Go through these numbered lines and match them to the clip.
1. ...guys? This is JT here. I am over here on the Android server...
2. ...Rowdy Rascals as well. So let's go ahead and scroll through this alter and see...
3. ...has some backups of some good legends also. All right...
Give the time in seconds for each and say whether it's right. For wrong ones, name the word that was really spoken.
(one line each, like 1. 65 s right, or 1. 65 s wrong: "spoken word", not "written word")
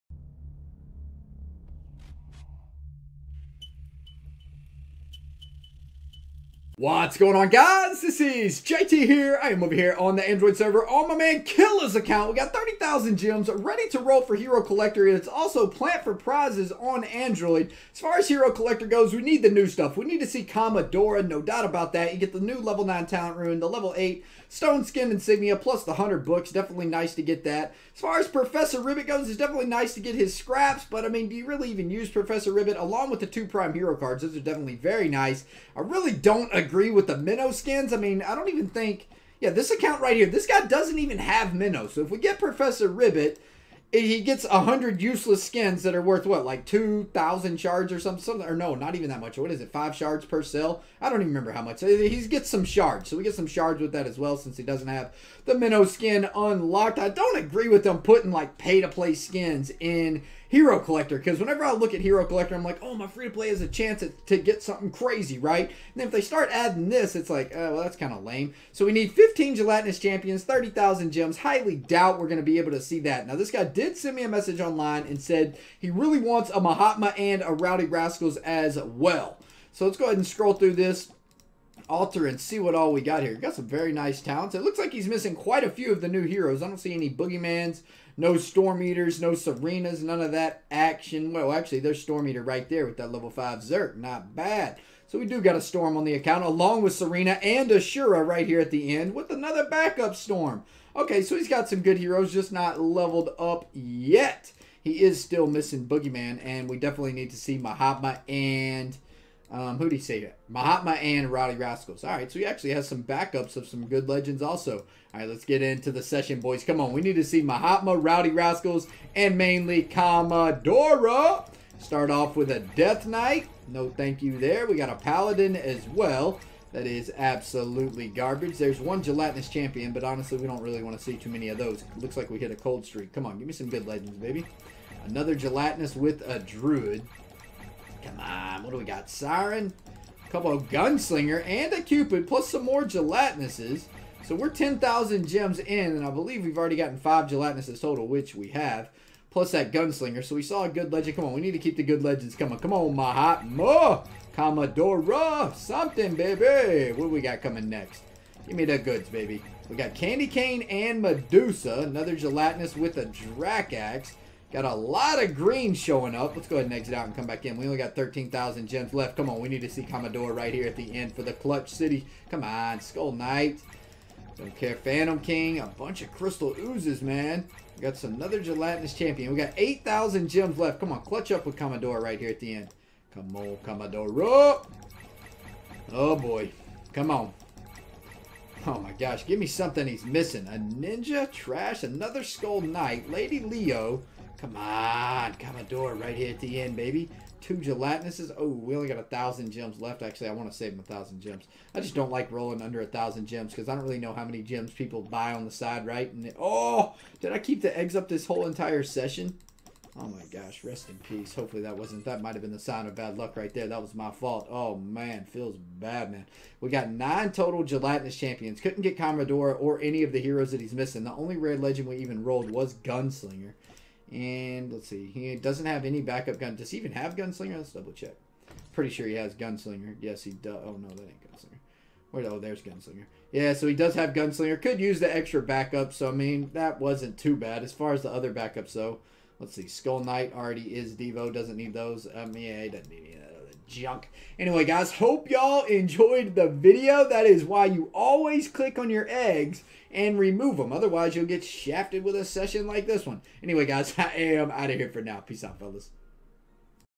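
1. 7 s right
2. 77 s right
3. 112 s right.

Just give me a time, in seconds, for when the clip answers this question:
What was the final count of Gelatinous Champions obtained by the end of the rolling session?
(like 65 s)
216 s.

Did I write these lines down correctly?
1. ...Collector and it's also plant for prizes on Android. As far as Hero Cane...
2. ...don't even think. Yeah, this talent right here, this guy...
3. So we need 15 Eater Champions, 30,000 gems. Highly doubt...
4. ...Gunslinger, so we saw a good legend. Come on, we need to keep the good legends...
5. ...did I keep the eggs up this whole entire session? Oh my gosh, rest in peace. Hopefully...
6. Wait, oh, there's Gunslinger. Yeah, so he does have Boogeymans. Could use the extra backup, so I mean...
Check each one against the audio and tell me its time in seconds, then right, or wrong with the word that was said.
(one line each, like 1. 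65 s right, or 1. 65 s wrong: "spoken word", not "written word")
1. 14 s wrong: "Collector", not "Cane"
2. 38 s wrong: "account", not "talent"
3. 68 s wrong: "Gelatinous", not "Eater"
4. 149 s right
5. 207 s right
6. 232 s wrong: "Gunslinger", not "Boogeymans".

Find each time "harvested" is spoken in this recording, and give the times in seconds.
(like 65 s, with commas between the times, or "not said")
not said.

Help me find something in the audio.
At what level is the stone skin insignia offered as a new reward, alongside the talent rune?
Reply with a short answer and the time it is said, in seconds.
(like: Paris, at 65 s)
8, at 23 s.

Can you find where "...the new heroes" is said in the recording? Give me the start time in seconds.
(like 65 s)
86 s.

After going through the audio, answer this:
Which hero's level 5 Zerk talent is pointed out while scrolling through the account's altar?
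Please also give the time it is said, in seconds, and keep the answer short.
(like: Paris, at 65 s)
Storm Eater, at 92 s.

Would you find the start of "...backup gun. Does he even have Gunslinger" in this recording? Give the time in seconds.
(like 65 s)
226 s.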